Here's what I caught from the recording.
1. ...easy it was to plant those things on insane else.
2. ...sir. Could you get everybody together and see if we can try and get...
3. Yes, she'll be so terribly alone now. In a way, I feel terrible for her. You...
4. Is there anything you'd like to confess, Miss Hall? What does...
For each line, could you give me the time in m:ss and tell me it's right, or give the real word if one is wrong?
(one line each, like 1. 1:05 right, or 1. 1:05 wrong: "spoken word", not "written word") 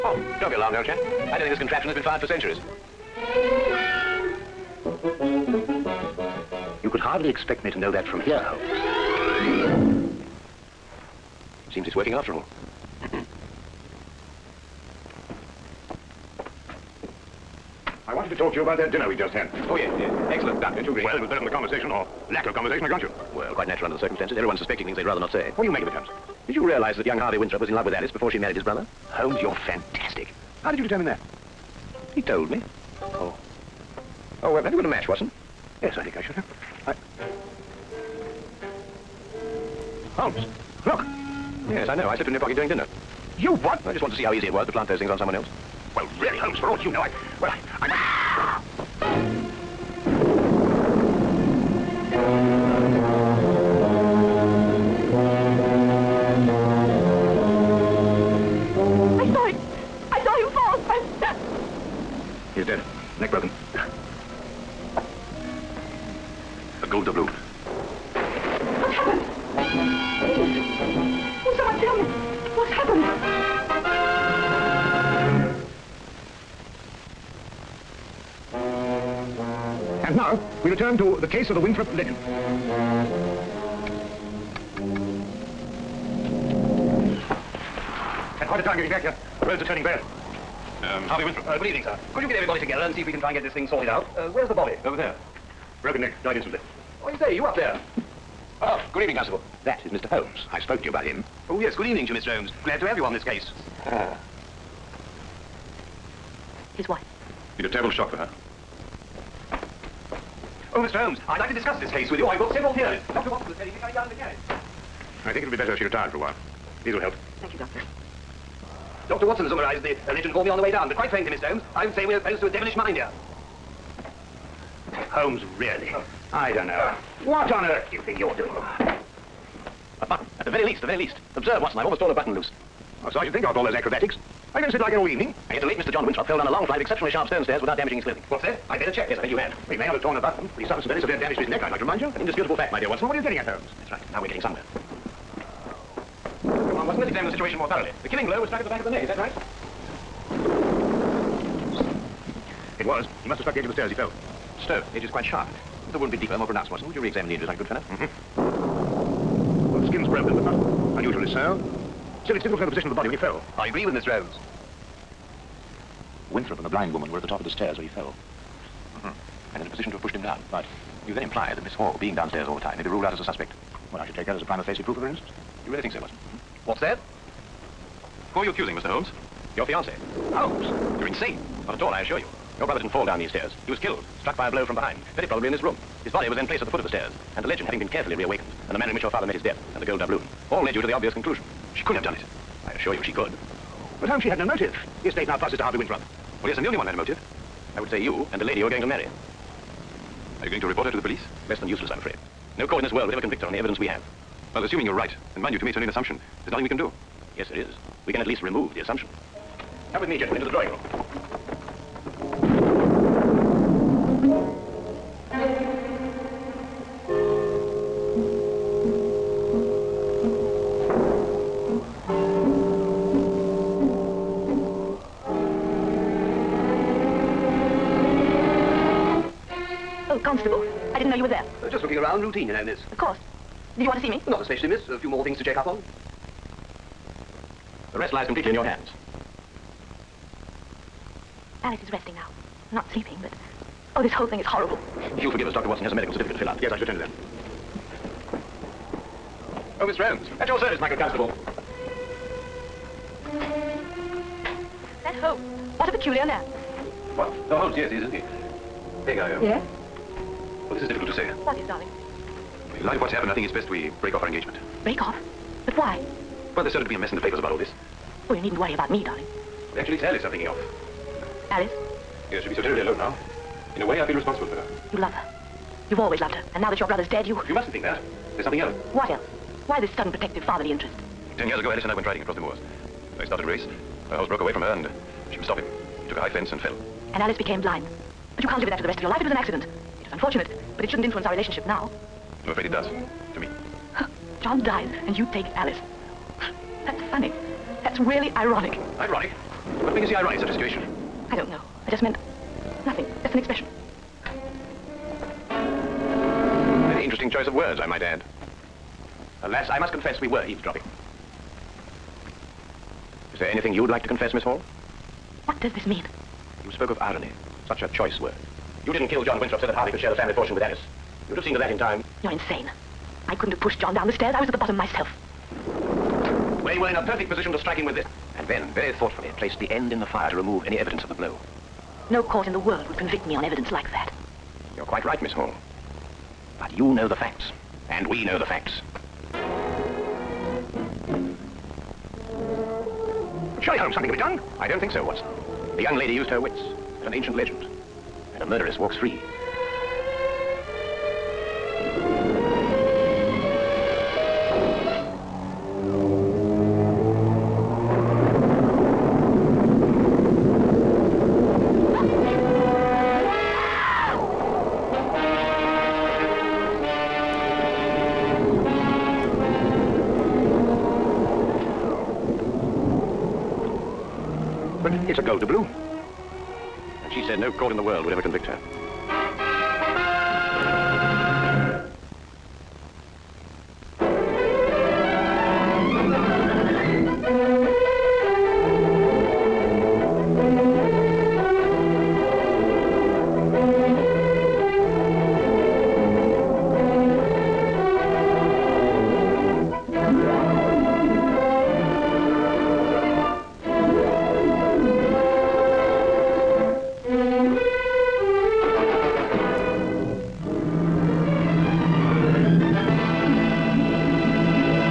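1. 0:44 wrong: "someone", not "insane"
2. 1:31 right
3. 4:32 wrong: "responsible", not "terrible"
4. 5:13 right.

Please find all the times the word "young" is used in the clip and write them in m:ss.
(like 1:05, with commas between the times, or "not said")
0:27, 5:45.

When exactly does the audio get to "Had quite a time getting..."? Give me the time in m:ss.
1:28.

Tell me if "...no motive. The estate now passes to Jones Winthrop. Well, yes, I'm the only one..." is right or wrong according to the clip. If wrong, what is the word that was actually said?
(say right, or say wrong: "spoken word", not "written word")
wrong: "Harvey", not "Jones".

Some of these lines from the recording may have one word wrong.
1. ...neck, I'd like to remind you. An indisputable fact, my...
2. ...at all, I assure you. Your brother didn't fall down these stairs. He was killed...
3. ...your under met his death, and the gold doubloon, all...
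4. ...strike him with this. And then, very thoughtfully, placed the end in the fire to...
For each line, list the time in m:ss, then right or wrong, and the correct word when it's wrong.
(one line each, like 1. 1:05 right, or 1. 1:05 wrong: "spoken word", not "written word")
1. 2:21 right
2. 3:01 right
3. 3:09 wrong: "father", not "under"
4. 5:27 right.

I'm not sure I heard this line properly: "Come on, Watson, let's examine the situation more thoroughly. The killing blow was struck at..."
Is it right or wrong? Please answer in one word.
right.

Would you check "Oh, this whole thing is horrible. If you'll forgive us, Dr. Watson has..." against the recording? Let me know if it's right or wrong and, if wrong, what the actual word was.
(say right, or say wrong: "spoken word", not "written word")
right.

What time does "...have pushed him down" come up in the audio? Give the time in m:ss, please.
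2:49.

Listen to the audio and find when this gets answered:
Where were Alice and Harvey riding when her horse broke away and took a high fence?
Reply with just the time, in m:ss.
4:42.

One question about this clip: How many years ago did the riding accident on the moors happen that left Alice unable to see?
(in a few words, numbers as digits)
10.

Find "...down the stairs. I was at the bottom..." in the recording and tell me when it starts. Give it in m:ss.
5:23.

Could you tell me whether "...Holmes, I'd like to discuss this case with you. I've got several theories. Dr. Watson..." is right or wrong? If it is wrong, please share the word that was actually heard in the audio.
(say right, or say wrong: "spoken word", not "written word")
right.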